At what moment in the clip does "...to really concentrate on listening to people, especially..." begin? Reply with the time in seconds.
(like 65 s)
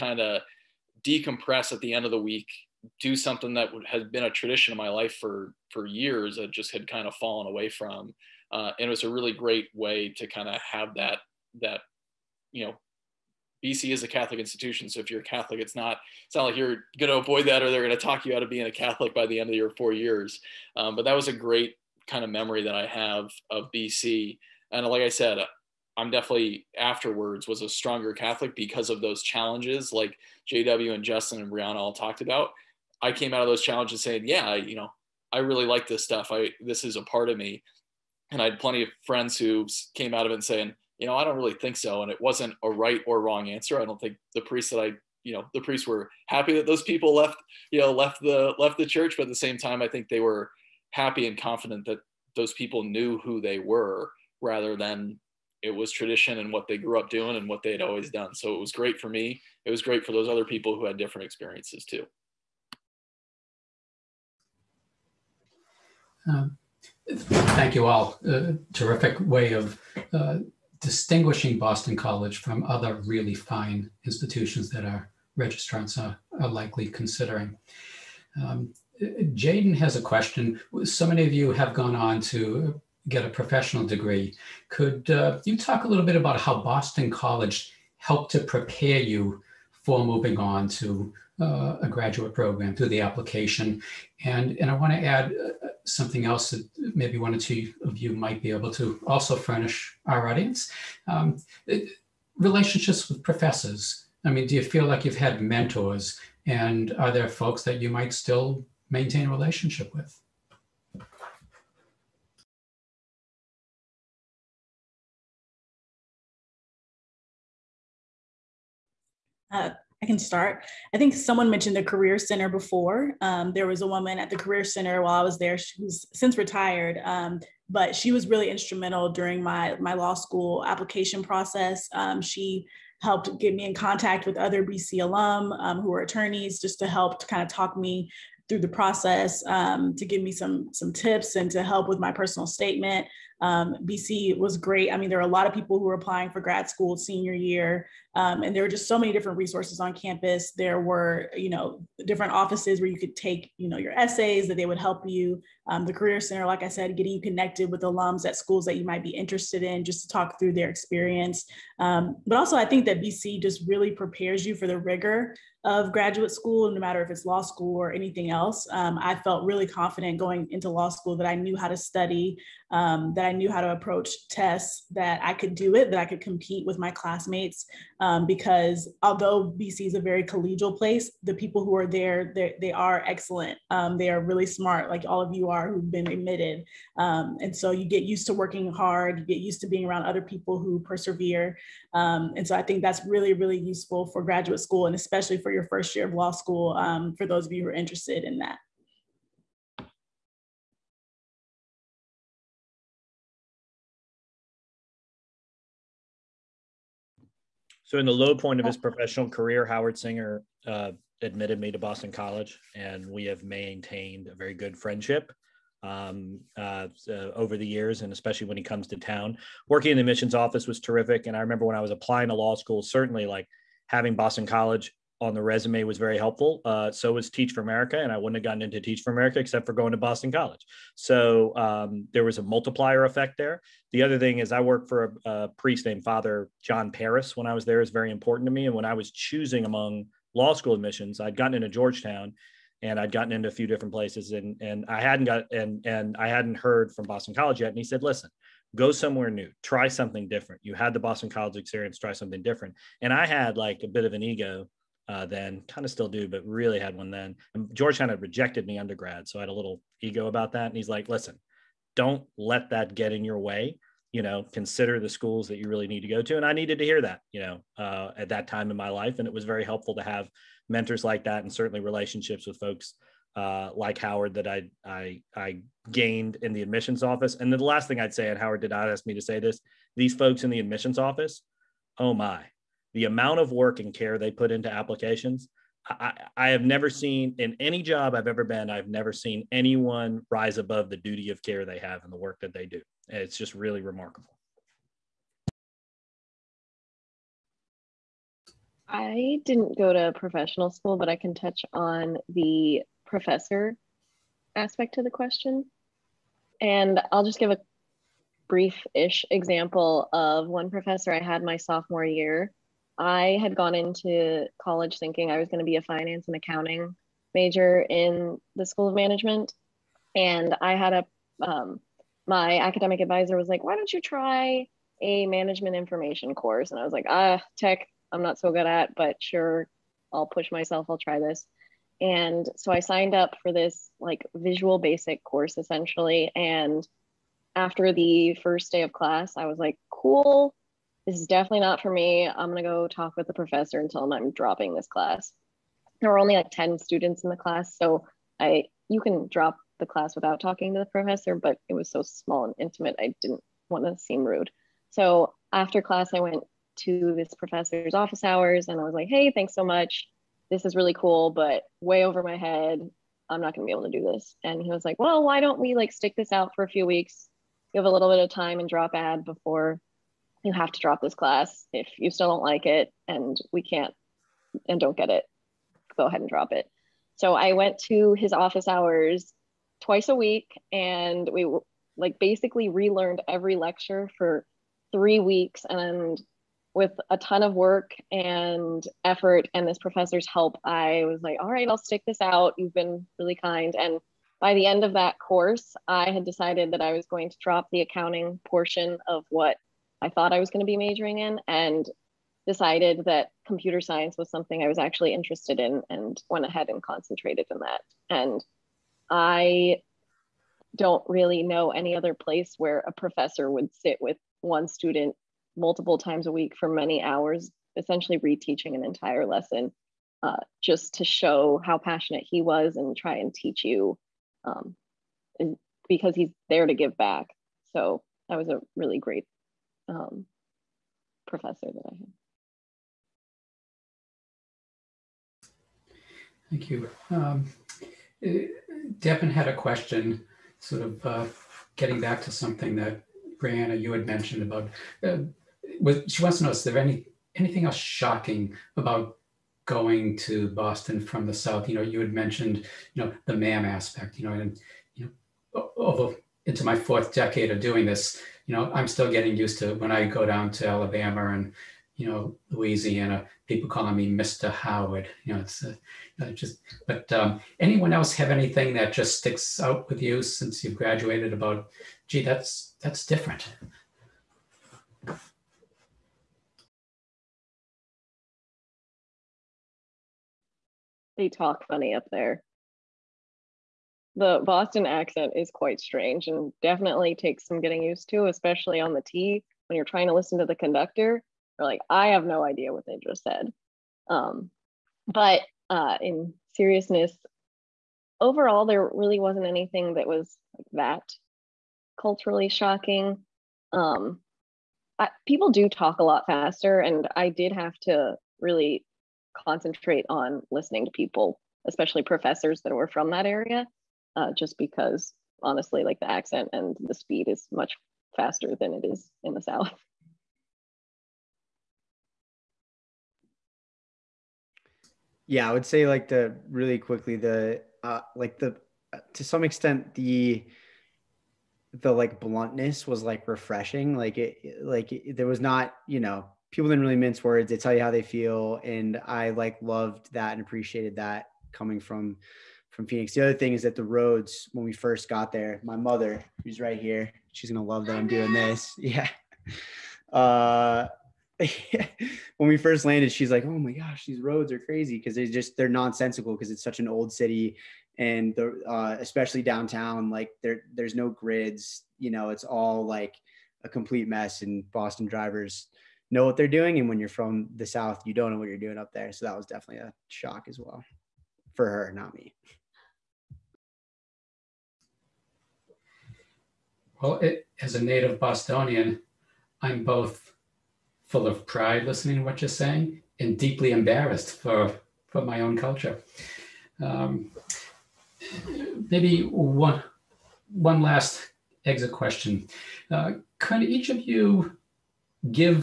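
507 s.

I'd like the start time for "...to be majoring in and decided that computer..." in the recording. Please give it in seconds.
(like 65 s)
400 s.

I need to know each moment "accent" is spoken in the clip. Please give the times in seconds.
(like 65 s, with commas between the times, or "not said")
484 s, 516 s.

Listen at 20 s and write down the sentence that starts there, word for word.
Um, but that was a great kind of memory that I have of BC.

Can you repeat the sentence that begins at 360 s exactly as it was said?
This is really cool, but way over my head.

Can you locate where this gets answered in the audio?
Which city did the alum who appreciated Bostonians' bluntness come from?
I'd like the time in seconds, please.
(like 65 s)
542 s.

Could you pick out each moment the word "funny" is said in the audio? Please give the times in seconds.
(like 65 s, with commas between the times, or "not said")
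481 s.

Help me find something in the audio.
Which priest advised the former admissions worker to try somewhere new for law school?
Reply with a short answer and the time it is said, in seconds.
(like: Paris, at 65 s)
Father John Paris, at 236 s.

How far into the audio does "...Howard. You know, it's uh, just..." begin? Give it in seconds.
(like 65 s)
464 s.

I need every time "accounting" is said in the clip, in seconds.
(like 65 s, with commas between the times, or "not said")
316 s, 397 s.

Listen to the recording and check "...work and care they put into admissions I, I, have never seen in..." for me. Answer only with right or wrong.
wrong.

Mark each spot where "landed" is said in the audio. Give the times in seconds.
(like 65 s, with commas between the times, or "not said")
552 s.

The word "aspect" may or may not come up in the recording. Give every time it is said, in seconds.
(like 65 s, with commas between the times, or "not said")
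304 s, 453 s.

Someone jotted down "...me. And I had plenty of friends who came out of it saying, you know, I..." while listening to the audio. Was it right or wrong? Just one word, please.
right.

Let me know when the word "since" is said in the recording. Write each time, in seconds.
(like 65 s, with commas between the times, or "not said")
126 s, 470 s.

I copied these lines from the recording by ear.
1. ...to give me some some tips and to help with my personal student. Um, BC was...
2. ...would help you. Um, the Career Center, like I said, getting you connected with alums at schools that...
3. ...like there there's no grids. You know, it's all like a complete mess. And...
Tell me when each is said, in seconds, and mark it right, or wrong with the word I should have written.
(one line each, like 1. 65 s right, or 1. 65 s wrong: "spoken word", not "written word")
1. 139 s wrong: "statement", not "student"
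2. 154 s right
3. 560 s right.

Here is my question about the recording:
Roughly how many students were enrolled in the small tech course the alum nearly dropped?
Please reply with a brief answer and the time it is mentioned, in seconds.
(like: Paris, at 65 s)
10, at 346 s.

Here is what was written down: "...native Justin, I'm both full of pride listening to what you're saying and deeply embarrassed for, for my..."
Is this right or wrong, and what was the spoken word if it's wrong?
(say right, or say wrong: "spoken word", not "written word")
wrong: "Bostonian", not "Justin".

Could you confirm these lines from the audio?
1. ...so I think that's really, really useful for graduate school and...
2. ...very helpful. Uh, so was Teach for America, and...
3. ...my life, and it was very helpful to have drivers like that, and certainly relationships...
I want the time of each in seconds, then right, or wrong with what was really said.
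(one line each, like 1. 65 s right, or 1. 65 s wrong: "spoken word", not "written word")
1. 192 s right
2. 225 s right
3. 268 s wrong: "mentors", not "drivers".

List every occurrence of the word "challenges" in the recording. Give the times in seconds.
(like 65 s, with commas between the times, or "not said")
29 s, 33 s.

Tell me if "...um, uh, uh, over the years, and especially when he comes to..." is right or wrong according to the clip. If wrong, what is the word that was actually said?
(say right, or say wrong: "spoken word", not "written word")
right.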